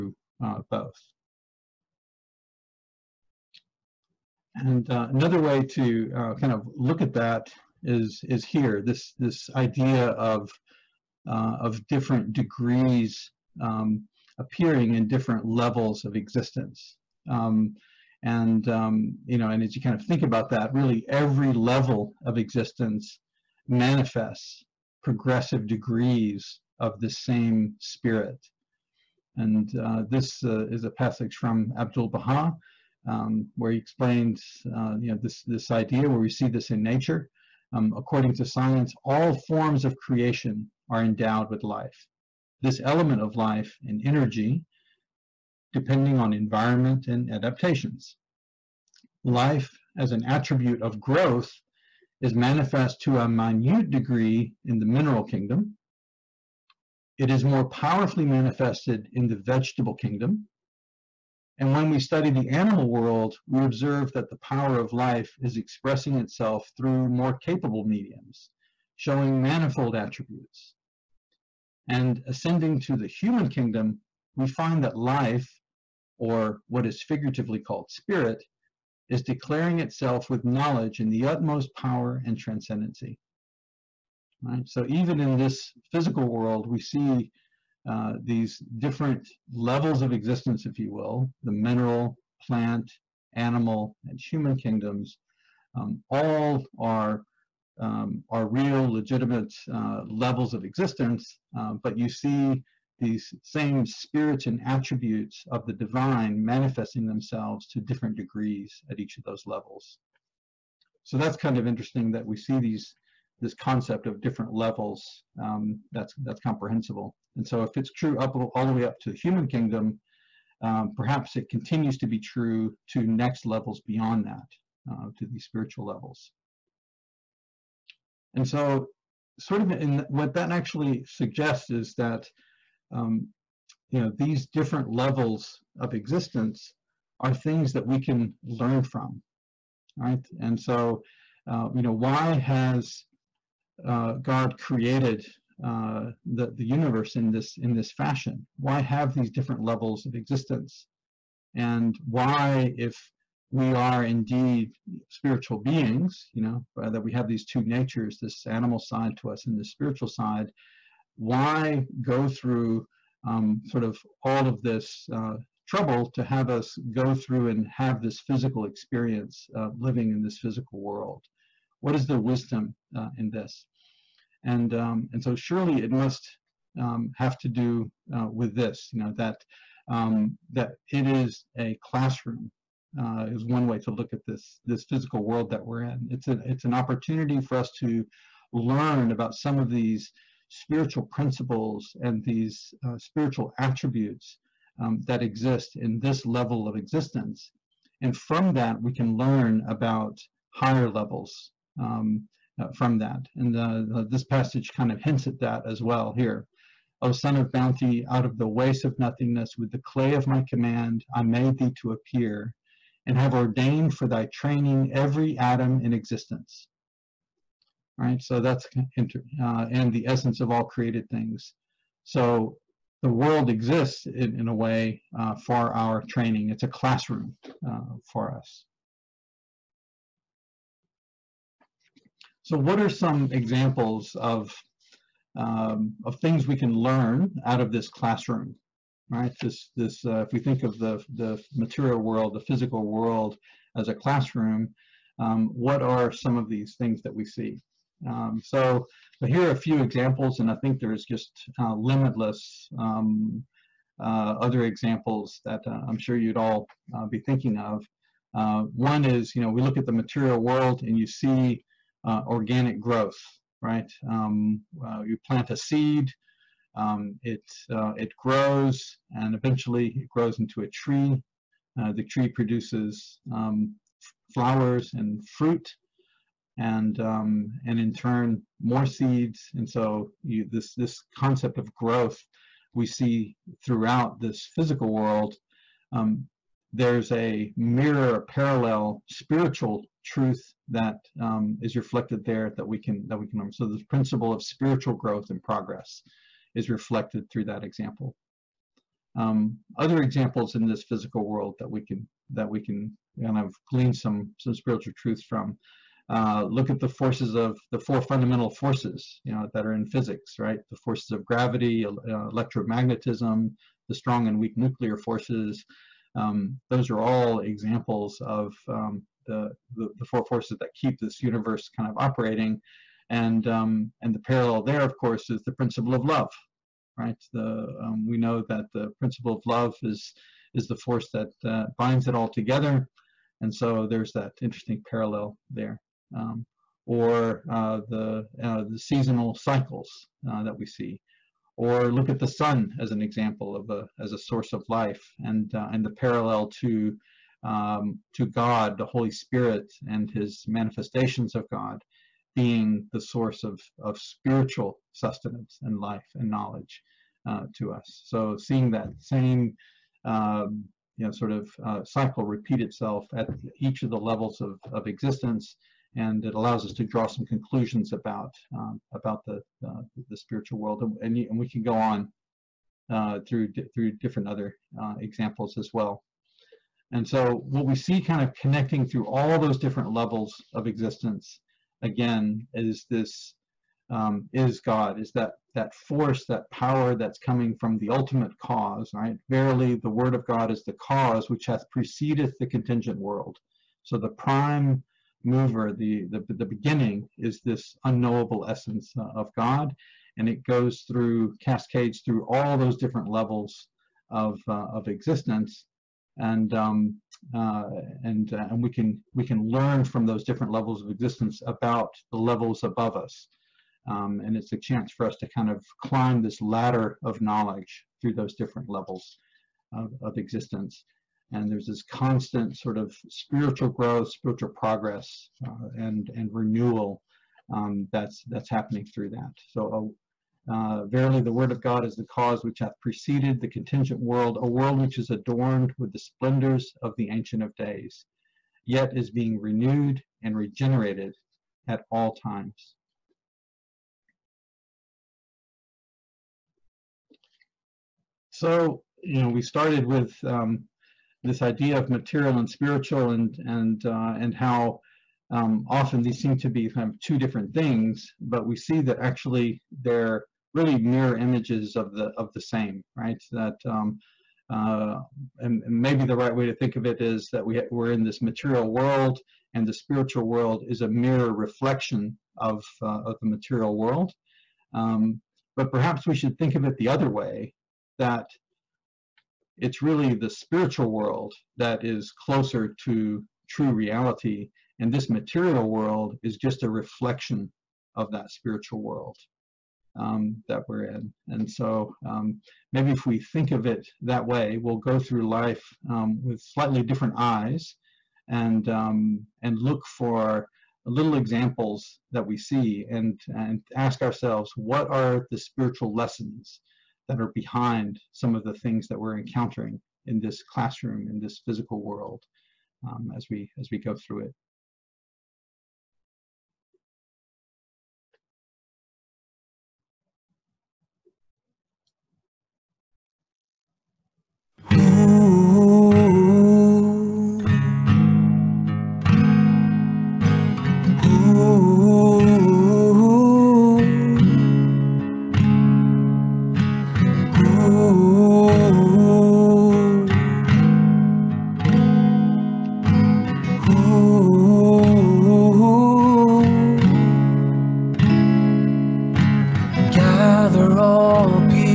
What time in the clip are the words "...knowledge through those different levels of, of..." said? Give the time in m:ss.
6:57.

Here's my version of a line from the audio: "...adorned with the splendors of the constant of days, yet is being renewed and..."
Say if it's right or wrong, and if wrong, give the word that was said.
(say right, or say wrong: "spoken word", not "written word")
wrong: "ancient", not "constant".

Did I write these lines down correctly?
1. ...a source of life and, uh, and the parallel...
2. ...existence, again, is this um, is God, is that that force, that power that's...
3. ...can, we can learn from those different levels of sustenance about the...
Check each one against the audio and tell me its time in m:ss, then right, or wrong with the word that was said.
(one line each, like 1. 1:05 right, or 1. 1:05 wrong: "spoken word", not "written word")
1. 5:44 right
2. 6:20 right
3. 6:48 wrong: "existence", not "sustenance".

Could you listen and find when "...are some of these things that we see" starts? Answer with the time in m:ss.
4:05.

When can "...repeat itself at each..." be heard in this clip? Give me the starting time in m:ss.
6:02.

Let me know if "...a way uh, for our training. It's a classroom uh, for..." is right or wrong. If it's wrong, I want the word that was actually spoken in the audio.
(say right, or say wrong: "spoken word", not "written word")
right.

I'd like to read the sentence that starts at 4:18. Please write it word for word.
Uh, one is, you know, we look at the material world and you see uh, organic growth, right?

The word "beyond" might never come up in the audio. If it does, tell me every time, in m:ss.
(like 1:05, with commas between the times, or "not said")
2:03.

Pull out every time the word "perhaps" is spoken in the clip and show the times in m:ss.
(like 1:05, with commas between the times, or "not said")
2:00, 7:55.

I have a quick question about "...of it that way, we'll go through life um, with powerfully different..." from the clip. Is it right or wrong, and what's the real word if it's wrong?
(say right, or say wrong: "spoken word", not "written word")
wrong: "slightly", not "powerfully".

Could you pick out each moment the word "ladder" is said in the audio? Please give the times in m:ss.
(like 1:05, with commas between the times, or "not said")
6:56.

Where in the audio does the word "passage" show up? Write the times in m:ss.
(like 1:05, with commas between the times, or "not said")
0:30, 3:24.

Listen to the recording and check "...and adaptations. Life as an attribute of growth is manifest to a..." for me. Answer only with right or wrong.
right.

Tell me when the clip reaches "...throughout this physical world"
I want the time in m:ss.
4:43.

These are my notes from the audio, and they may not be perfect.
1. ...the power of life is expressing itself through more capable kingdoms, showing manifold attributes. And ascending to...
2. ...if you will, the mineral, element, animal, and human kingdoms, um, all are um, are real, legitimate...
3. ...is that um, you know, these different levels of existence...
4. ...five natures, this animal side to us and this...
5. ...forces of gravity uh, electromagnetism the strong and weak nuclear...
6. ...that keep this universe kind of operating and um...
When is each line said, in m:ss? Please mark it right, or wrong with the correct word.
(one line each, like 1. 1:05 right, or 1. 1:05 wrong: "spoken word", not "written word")
1. 1:04 wrong: "mediums", not "kingdoms"
2. 1:30 wrong: "plant", not "element"
3. 2:11 right
4. 2:37 wrong: "two", not "five"
5. 5:10 right
6. 5:20 right.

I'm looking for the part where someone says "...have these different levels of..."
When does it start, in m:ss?
2:28.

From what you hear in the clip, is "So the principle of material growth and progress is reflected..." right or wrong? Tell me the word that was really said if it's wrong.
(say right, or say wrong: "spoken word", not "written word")
wrong: "spiritual", not "material".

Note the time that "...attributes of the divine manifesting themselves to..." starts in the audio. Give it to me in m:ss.
1:44.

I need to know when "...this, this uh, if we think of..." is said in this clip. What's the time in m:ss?
3:59.